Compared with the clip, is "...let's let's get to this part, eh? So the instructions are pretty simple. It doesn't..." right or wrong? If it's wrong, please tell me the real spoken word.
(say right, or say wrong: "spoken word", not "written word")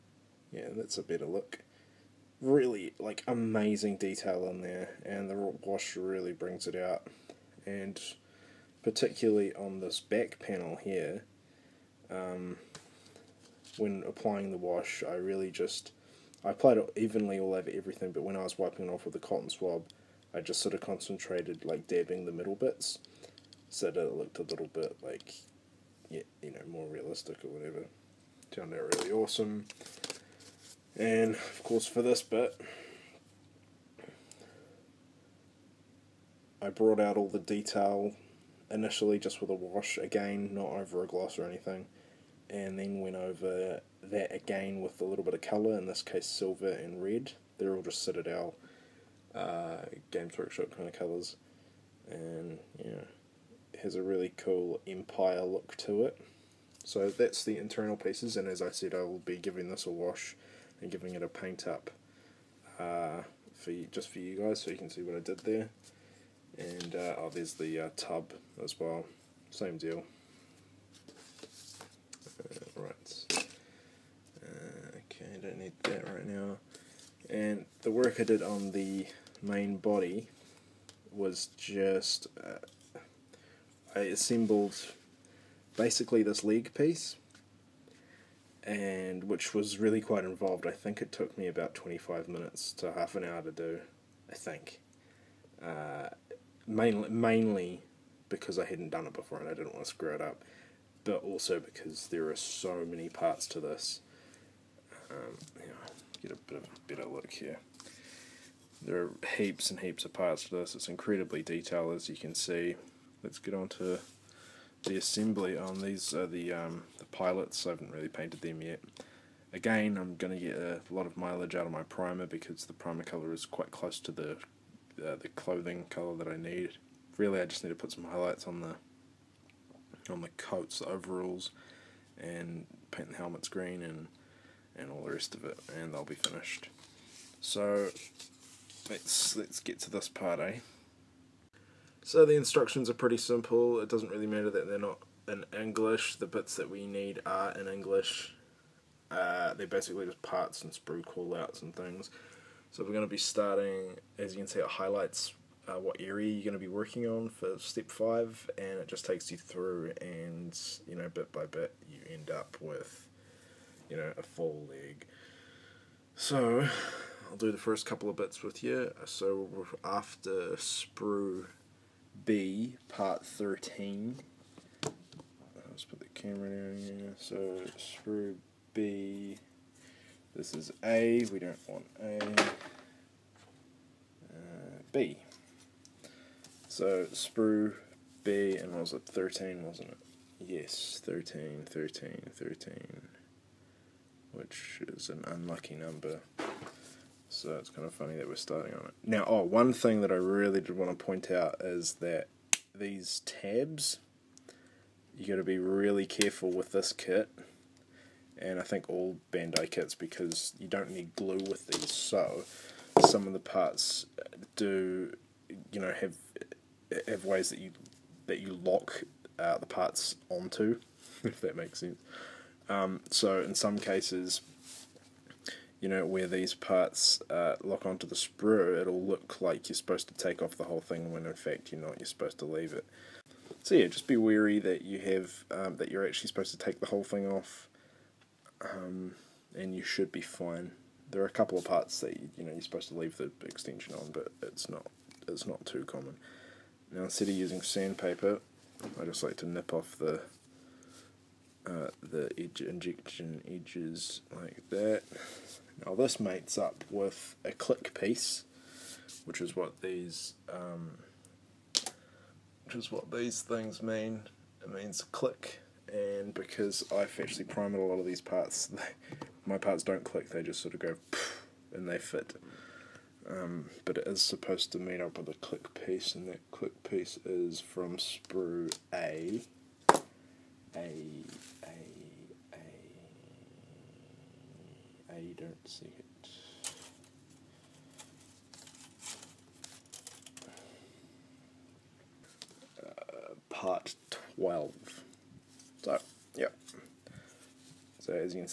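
right.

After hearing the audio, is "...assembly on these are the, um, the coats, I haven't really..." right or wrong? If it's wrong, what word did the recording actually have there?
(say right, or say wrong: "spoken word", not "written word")
wrong: "pilots", not "coats".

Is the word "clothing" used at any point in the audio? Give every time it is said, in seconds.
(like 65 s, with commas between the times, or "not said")
125 s.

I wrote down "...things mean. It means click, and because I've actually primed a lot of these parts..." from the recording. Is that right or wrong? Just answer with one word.
right.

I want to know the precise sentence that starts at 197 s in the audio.
So it's kind of funny that we're starting on it.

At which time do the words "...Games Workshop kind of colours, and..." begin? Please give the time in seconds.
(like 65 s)
50 s.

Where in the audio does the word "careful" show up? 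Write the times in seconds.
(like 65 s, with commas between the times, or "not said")
206 s.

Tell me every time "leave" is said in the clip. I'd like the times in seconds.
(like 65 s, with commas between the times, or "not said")
232 s, 242 s.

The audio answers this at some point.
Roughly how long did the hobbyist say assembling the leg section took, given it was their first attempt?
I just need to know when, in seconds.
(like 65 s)
91 s.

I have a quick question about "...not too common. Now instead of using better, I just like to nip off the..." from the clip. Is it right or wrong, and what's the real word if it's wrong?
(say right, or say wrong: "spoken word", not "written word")
wrong: "sandpaper", not "better".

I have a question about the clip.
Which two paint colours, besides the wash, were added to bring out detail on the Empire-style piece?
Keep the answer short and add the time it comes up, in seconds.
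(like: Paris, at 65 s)
silver and red, at 46 s.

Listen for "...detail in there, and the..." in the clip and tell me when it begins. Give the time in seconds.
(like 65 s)
3 s.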